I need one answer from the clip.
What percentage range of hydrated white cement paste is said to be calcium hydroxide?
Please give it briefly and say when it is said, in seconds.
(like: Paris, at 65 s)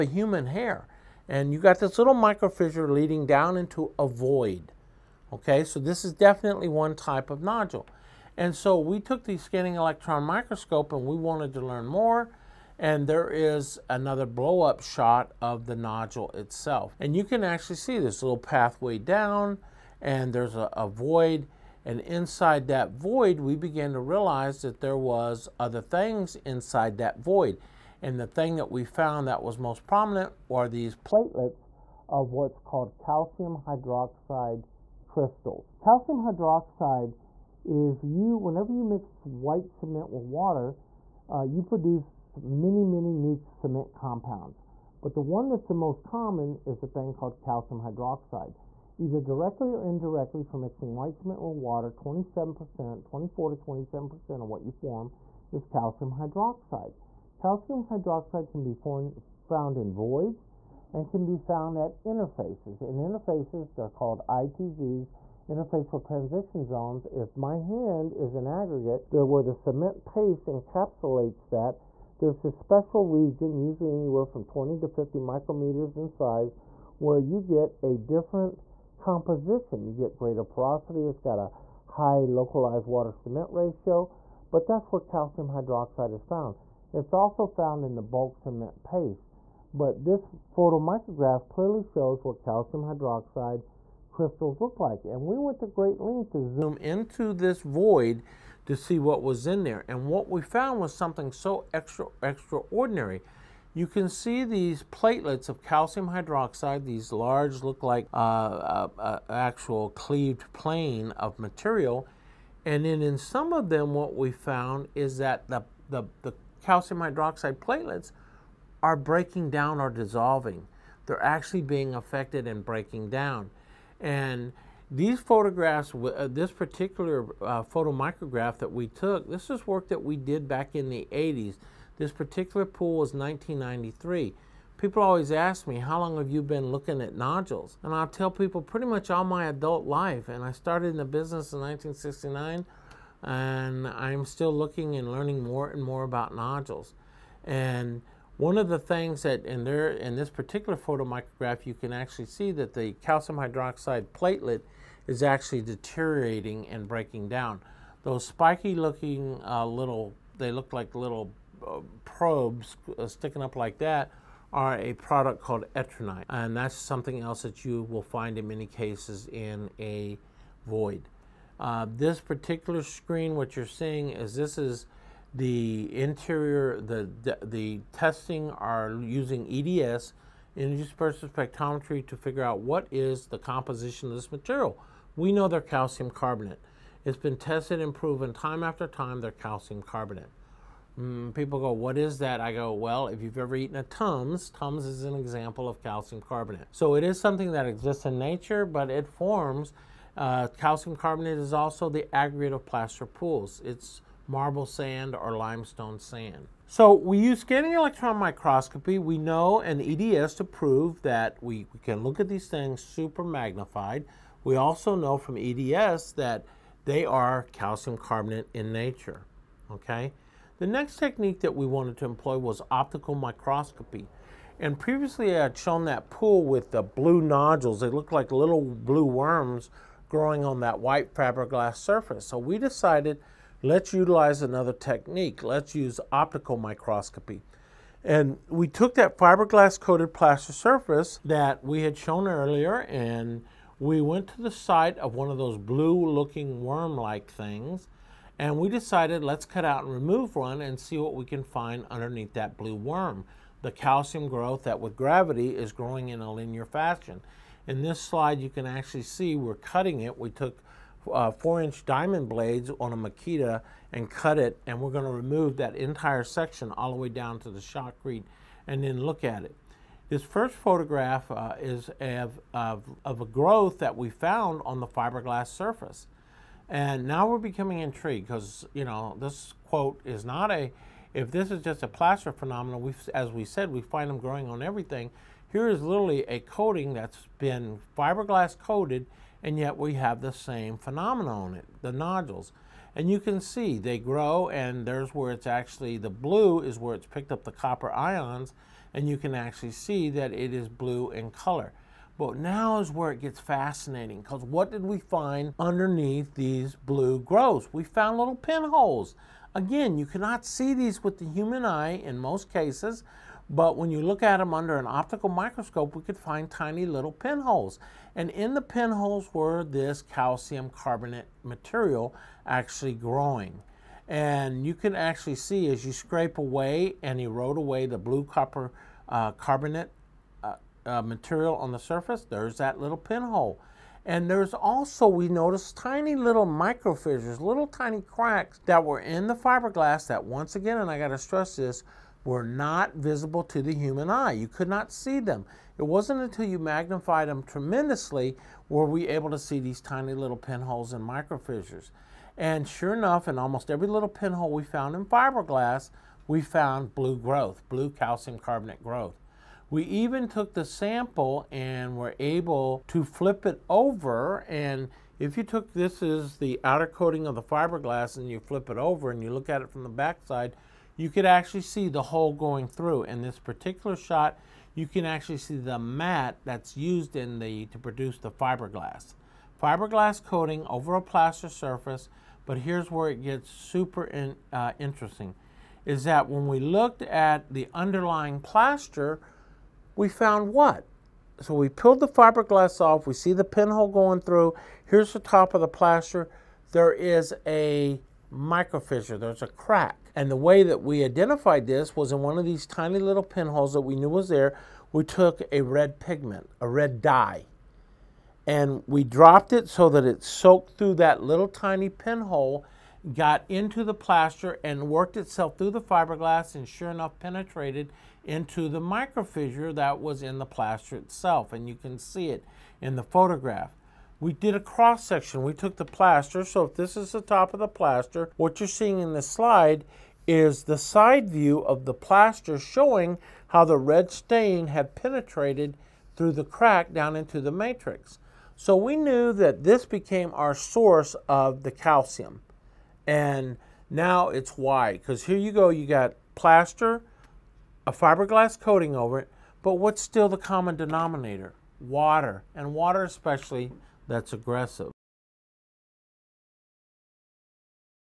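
24 to 27%, at 53 s.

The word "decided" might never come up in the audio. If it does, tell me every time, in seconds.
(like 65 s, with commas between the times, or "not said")
232 s, 248 s.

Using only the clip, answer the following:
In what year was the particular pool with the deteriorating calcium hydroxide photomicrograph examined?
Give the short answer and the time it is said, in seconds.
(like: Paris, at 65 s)
1993, at 133 s.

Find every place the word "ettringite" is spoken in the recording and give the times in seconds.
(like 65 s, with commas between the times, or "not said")
165 s.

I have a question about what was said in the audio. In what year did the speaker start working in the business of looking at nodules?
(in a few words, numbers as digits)
1969.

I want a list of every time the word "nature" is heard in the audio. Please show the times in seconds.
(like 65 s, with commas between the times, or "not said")
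198 s, 218 s.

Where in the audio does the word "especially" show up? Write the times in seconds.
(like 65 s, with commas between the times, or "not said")
453 s.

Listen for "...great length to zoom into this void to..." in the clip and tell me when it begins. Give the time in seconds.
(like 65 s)
95 s.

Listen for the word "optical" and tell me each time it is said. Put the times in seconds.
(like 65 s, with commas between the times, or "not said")
222 s, 236 s, 314 s.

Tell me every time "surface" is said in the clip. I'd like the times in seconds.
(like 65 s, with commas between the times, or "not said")
231 s, 240 s, 275 s, 331 s, 381 s.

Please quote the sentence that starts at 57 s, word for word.
Calcium hydroxide can be found in voids and can be found at interfaces.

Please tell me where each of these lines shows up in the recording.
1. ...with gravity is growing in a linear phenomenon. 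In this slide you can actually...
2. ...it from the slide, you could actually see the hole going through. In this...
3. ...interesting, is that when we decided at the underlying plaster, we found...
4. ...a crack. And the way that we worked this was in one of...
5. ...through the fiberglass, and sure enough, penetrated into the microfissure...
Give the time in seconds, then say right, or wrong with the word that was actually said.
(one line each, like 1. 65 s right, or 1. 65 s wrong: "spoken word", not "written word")
1. 254 s wrong: "fashion", not "phenomenon"
2. 369 s wrong: "backside", not "slide"
3. 384 s wrong: "looked", not "decided"
4. 399 s wrong: "identified", not "worked"
5. 415 s right.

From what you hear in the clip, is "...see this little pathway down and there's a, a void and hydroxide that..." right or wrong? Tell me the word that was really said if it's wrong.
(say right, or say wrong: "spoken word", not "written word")
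wrong: "inside", not "hydroxide".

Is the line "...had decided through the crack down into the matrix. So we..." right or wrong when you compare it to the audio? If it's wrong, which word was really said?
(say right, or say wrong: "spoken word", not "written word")
wrong: "penetrated", not "decided".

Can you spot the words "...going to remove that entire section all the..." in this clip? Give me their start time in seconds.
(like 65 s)
264 s.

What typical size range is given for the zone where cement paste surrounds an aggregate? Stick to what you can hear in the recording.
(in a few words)
20 to 50 micrometers.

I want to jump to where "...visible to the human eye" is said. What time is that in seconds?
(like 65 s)
342 s.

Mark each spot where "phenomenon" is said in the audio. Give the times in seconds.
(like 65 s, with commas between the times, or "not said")
282 s, 290 s.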